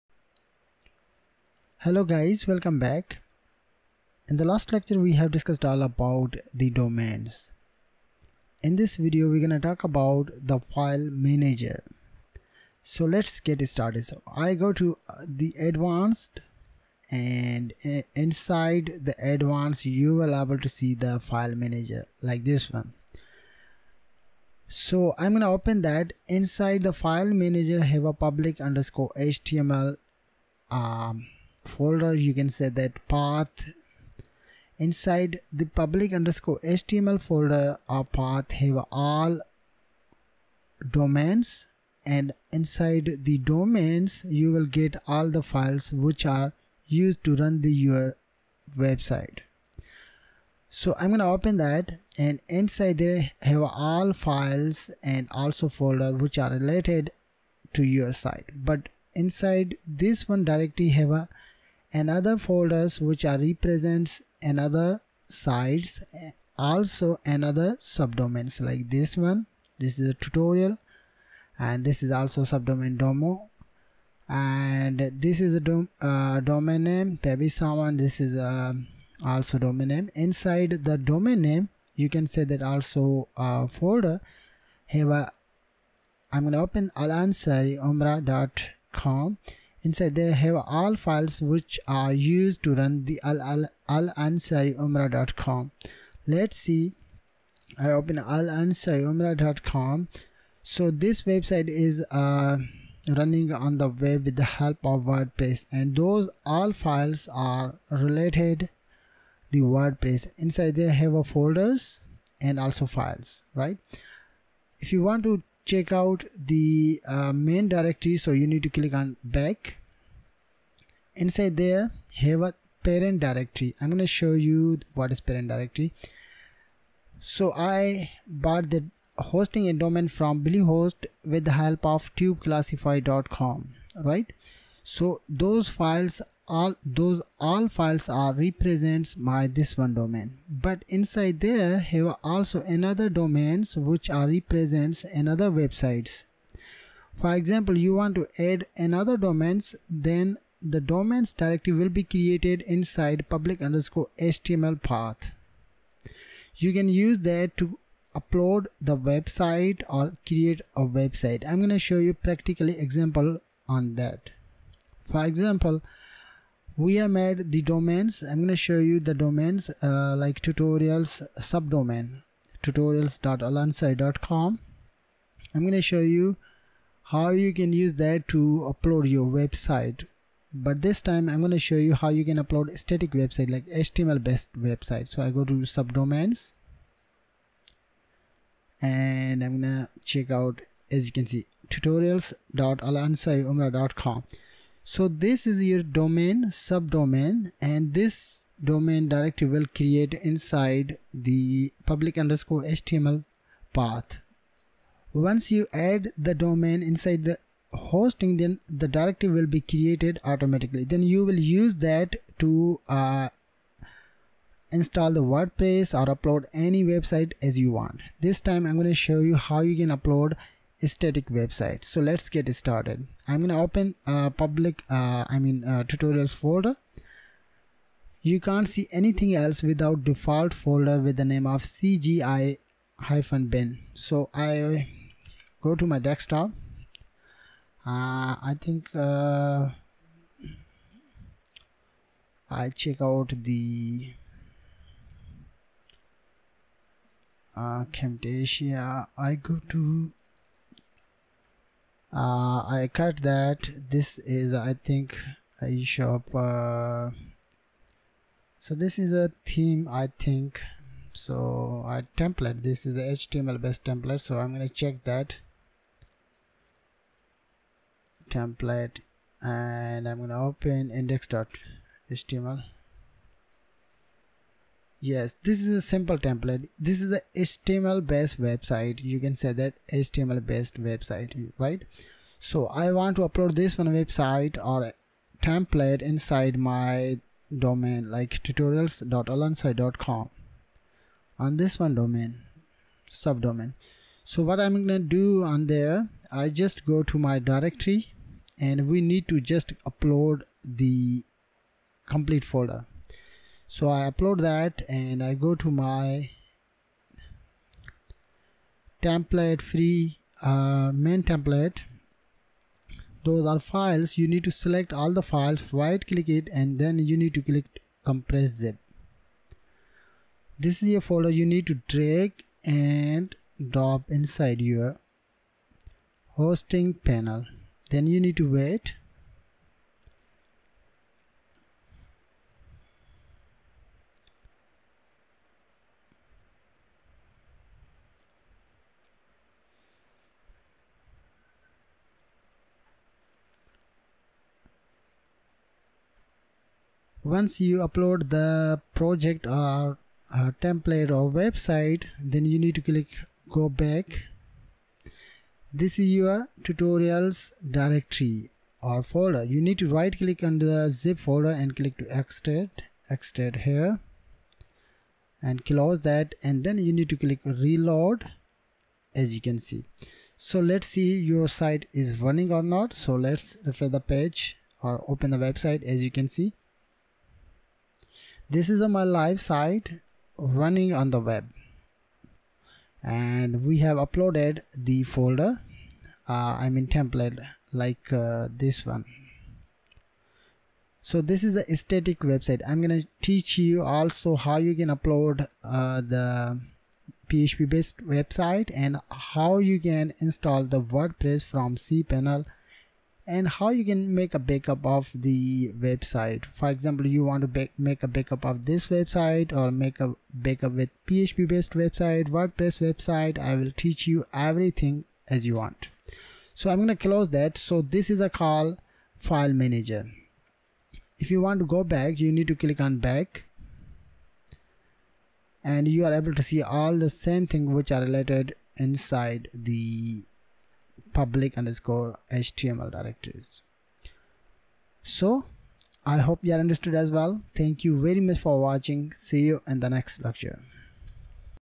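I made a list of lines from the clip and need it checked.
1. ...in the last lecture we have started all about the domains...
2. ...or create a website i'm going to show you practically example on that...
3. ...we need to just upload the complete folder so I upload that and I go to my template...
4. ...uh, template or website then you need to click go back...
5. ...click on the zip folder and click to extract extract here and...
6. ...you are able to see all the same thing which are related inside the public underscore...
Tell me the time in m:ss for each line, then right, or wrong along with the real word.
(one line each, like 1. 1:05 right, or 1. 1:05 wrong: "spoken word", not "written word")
1. 0:04 wrong: "discussed", not "started"
2. 2:39 right
3. 4:58 right
4. 5:50 right
5. 6:00 right
6. 7:05 right.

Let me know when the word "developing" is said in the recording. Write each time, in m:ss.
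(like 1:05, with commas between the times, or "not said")
not said.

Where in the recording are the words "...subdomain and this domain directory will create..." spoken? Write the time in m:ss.
3:16.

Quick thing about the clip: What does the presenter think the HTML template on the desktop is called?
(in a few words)
eShop.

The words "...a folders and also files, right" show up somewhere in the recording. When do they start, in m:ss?
1:51.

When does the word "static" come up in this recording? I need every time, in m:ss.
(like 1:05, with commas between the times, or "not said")
3:02, 3:40, 6:31.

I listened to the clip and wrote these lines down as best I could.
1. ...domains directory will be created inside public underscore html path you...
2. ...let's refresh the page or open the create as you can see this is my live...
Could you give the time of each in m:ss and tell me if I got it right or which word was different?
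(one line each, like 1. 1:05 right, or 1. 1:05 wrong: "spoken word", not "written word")
1. 2:30 right
2. 6:13 wrong: "website", not "create".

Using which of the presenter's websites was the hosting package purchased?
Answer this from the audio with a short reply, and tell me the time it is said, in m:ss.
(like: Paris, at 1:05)
tubeclassify.com, at 2:12.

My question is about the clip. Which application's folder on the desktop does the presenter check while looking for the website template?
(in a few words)
Camtasia.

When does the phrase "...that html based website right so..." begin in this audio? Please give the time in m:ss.
4:39.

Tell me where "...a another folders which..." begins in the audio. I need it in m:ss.
1:01.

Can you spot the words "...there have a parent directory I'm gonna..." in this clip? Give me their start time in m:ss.
2:01.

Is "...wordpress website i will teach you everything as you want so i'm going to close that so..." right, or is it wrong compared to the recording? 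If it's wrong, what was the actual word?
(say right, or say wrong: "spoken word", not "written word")
right.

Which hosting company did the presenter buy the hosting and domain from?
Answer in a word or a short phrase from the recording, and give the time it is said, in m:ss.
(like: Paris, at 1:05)
Bluehost, at 2:10.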